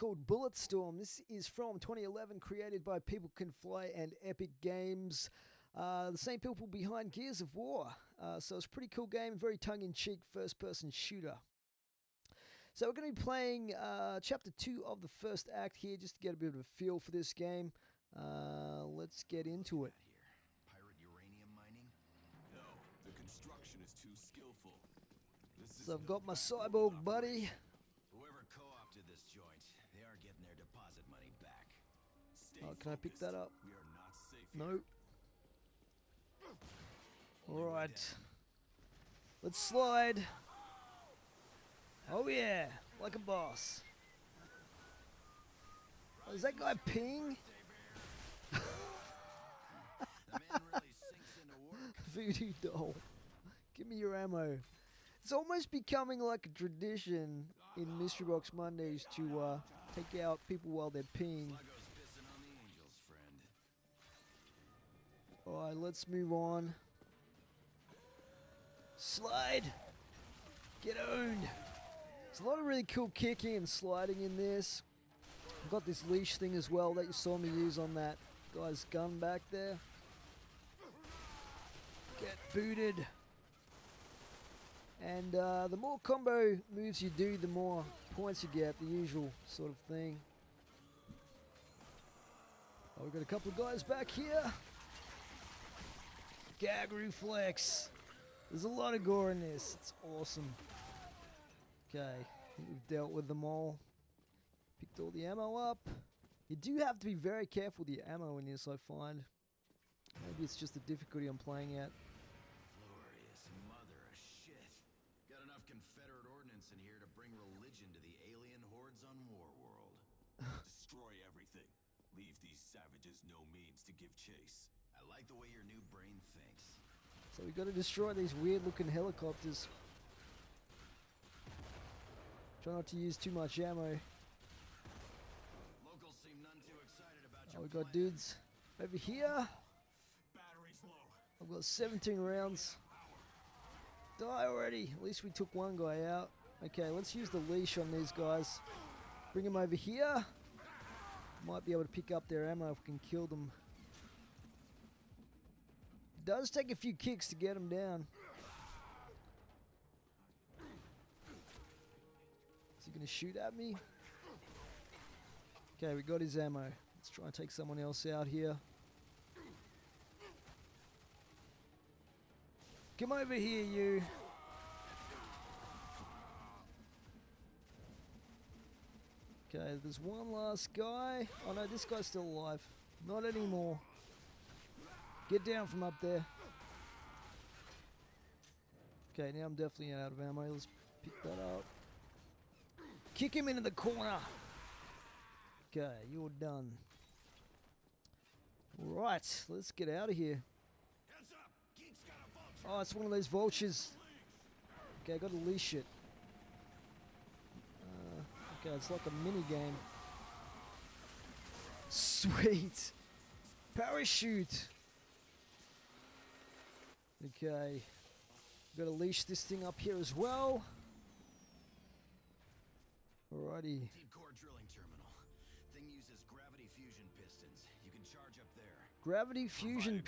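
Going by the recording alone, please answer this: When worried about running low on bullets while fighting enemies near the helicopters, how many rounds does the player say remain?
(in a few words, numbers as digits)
17.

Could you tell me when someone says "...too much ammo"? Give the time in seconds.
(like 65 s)
133 s.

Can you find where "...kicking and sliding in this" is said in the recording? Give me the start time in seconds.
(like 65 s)
73 s.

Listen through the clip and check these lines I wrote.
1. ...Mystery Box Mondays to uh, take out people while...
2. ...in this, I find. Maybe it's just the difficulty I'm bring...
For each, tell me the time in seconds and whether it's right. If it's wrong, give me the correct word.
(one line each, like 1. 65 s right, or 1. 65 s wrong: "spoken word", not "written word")
1. 57 s right
2. 108 s wrong: "playing", not "bring".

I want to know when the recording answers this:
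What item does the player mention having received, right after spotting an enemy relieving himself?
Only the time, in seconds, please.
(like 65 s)
51 s.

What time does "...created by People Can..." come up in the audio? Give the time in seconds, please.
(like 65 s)
2 s.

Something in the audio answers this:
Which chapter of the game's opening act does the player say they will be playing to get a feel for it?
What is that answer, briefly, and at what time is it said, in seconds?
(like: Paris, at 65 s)
Chapter 2, at 14 s.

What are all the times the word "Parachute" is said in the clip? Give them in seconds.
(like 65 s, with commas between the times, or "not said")
213 s.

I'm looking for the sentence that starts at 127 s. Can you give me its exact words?
So we gotta destroy these weird looking helicopters.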